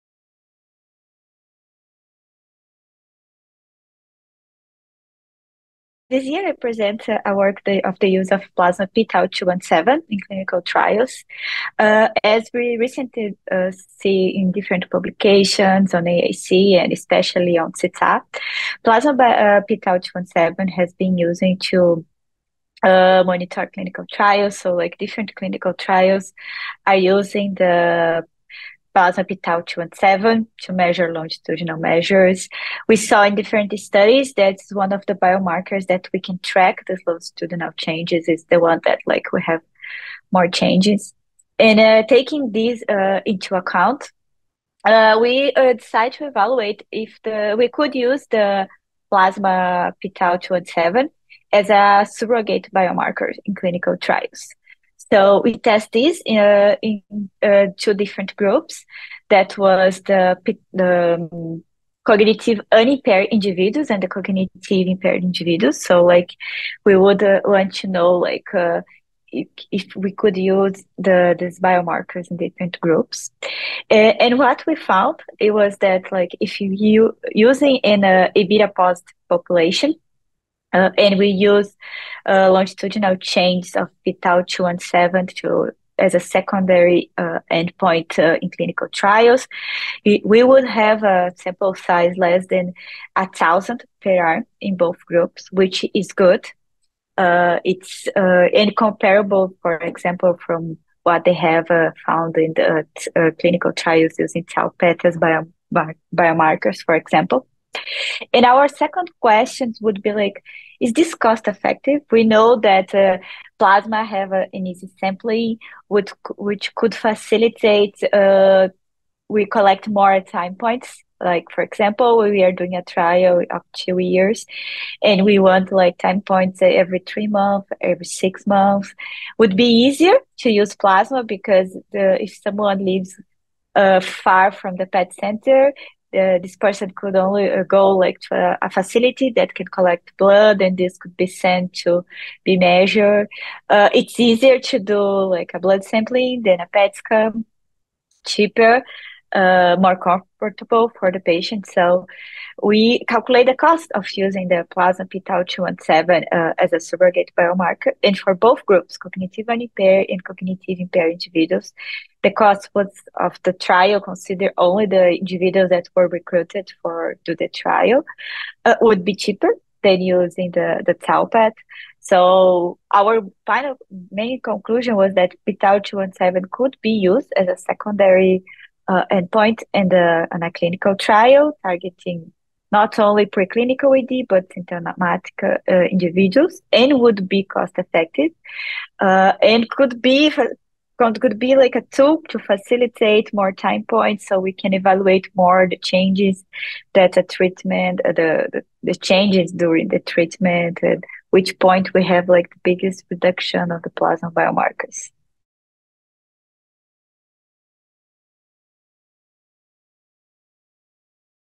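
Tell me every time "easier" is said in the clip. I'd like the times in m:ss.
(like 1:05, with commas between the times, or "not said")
2:09, 2:24.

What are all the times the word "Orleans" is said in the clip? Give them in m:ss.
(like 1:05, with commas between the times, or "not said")
not said.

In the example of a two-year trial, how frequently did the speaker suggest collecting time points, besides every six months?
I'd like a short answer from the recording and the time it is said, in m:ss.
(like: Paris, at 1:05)
Every 3 months, at 2:06.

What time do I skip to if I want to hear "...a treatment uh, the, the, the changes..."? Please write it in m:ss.
3:17.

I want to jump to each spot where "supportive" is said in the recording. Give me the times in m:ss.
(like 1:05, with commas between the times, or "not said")
not said.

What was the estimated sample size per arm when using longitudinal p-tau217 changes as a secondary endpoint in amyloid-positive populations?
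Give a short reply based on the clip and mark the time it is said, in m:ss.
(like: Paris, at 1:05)
Less than 1,000, at 1:32.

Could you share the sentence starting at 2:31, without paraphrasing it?
So we calculate the cost of using the plasma p-tau217 uh, as a surrogate biomarker.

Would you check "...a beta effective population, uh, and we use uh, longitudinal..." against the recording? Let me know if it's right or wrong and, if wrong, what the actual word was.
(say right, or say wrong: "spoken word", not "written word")
wrong: "positive", not "effective".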